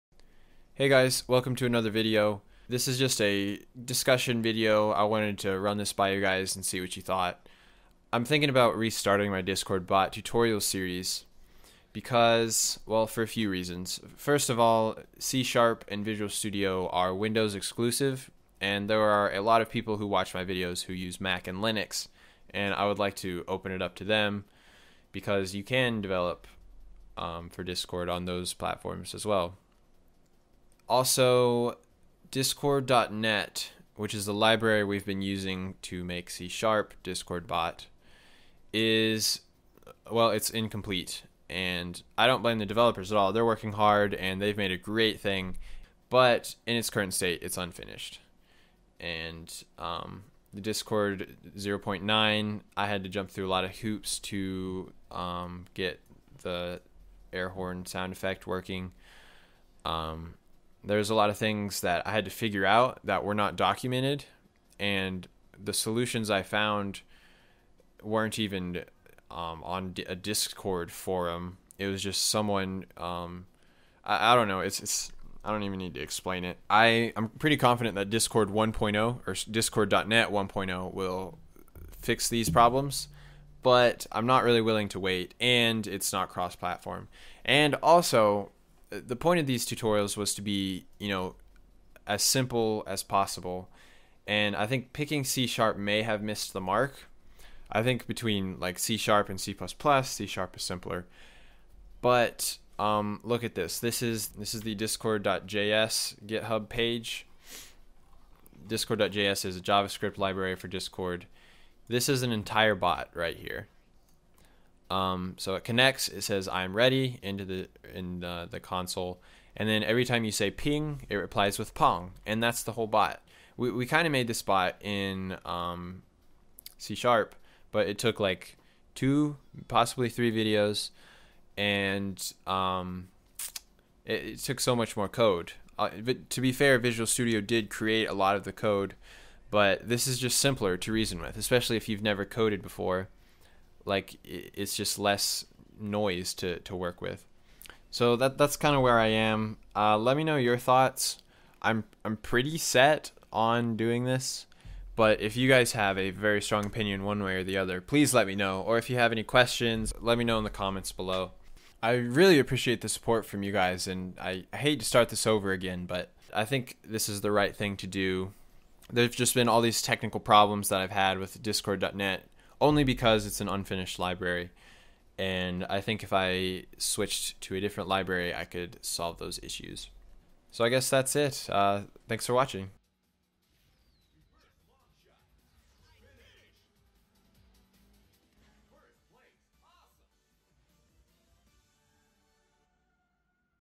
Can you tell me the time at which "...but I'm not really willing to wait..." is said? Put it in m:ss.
1:23.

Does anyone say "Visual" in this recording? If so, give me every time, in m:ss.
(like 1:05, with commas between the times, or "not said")
0:16, 2:16.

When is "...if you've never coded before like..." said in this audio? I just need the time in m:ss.
2:21.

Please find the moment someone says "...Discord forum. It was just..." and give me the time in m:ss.
1:10.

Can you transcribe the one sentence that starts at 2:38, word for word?
Or if you have any questions, let me know in the comments below.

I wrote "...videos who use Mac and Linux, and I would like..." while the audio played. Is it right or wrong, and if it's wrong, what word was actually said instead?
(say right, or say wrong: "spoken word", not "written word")
right.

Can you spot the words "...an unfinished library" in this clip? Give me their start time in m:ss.
2:53.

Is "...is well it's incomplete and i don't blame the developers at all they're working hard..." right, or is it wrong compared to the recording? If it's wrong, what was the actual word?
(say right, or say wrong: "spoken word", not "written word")
right.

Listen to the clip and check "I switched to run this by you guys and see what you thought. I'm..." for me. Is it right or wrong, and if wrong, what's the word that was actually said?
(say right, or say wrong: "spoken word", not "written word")
wrong: "wanted", not "switched".